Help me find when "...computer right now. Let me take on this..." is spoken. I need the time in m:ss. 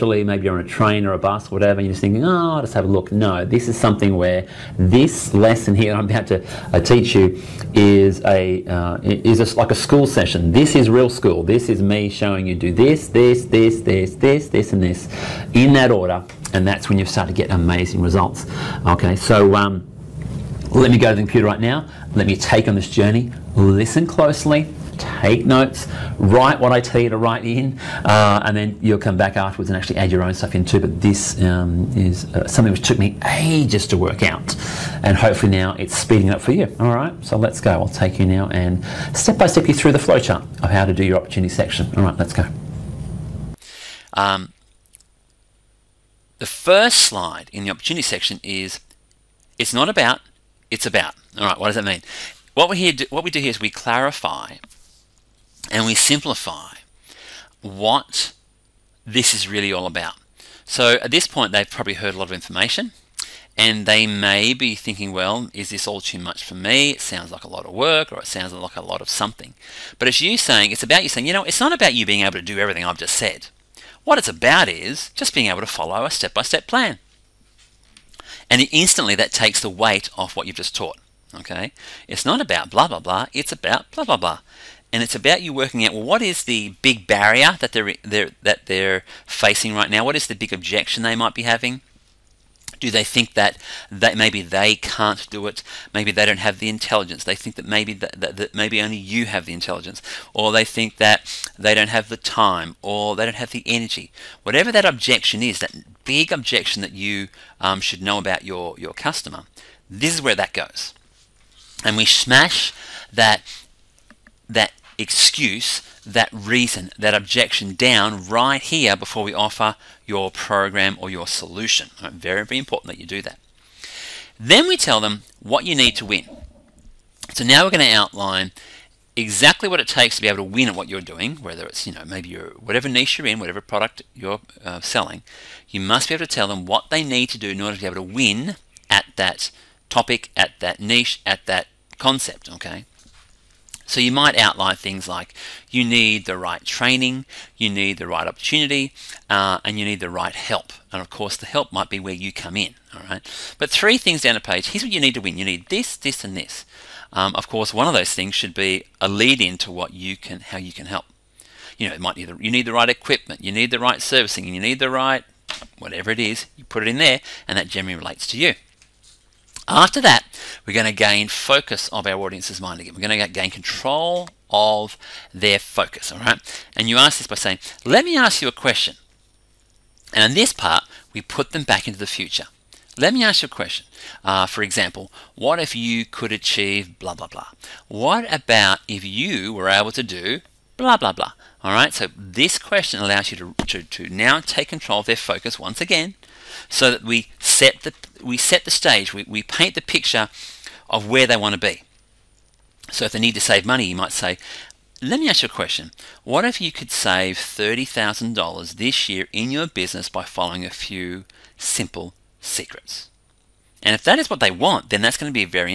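0:21.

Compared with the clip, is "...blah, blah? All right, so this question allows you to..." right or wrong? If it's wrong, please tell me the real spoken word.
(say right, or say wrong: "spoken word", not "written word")
right.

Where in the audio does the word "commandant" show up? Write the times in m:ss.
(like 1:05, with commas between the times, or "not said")
not said.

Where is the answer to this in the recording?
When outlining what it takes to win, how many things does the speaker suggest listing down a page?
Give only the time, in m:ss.
2:33.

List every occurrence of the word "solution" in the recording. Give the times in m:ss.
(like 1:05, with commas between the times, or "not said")
2:01.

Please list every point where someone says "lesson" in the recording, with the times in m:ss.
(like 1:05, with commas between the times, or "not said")
0:05.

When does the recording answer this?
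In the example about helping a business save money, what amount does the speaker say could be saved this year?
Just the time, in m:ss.
3:27.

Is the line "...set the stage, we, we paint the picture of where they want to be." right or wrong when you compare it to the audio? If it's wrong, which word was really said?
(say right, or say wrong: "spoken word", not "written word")
right.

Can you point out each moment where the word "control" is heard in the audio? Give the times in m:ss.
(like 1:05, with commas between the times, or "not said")
2:53, 3:14.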